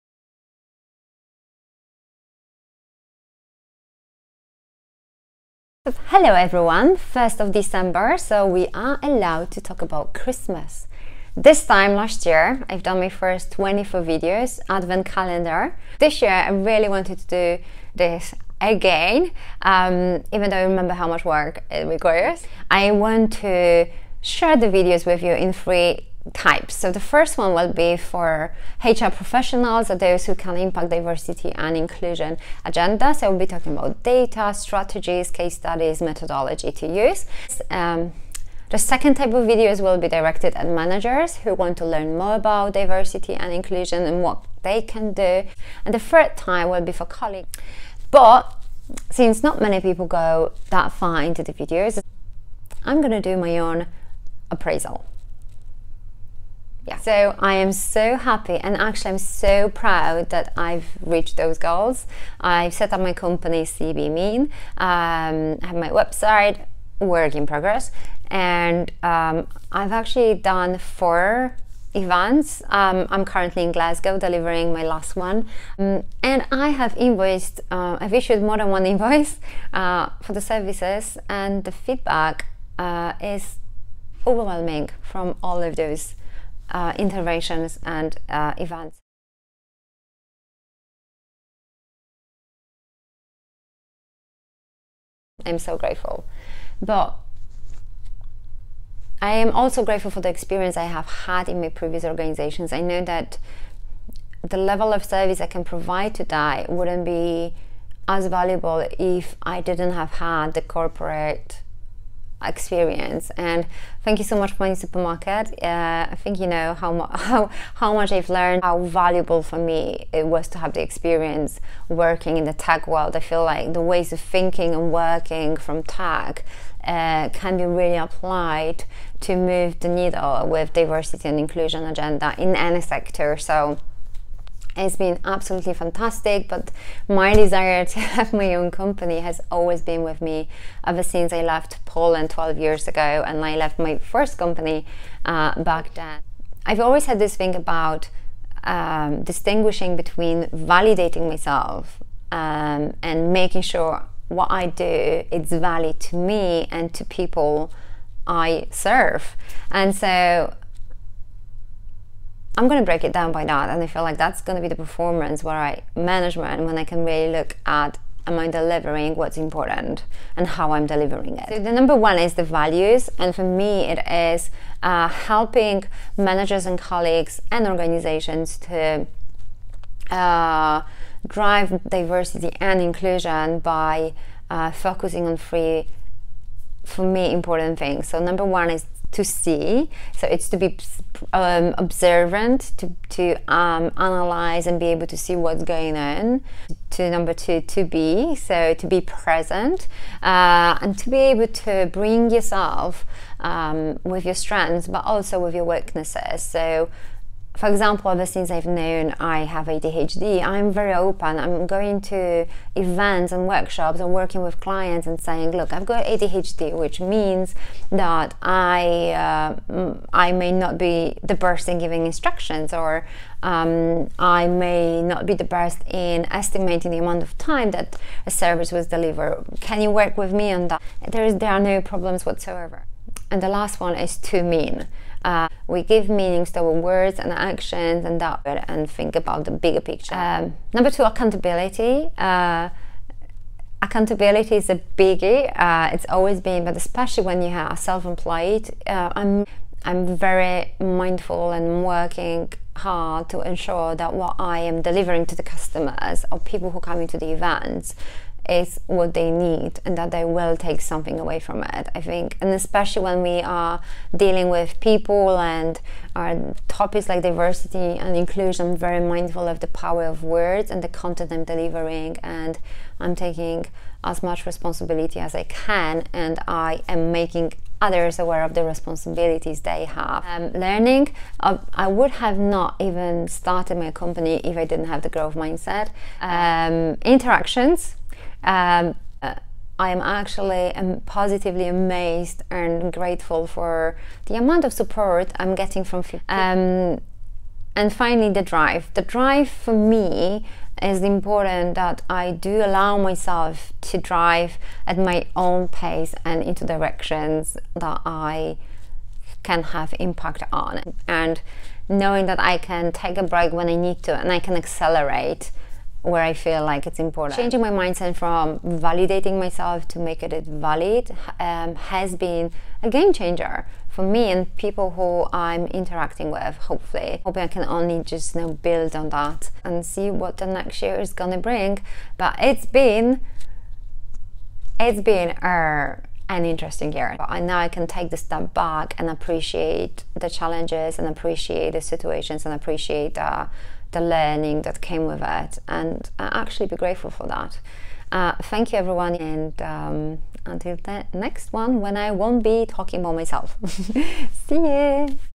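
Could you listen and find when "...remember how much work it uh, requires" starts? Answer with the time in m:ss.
0:20.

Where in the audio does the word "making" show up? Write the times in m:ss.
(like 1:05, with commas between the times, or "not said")
2:33, 4:37.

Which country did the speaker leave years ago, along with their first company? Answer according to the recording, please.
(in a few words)
Poland.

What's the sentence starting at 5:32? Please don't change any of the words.
But it's been, it's been uh, an interesting year.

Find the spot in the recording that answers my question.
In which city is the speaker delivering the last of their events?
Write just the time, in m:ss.
1:13.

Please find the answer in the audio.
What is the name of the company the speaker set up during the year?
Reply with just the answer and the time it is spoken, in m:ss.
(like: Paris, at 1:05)
CB Mean, at 1:03.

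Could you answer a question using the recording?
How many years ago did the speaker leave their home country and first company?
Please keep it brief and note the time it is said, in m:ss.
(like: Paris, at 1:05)
12, at 2:22.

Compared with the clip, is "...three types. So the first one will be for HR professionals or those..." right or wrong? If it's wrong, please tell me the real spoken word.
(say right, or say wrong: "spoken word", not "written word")
right.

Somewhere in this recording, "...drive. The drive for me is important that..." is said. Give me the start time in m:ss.
4:58.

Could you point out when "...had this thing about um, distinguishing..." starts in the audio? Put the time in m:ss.
2:27.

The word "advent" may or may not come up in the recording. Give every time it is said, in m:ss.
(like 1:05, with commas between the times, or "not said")
0:14.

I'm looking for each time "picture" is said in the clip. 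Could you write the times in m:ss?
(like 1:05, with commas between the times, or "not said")
3:59.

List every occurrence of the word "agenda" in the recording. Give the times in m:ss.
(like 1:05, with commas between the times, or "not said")
0:32, 2:11.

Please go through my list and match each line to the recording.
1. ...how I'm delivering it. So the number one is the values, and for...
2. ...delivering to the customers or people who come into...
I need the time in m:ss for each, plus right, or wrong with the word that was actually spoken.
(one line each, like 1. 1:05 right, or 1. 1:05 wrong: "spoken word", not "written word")
1. 2:50 right
2. 4:14 right.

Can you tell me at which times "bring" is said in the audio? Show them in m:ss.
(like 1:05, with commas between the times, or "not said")
3:21, 5:31.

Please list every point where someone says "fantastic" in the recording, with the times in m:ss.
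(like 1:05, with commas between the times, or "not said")
2:15.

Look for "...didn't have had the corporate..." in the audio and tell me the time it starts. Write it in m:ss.
1:49.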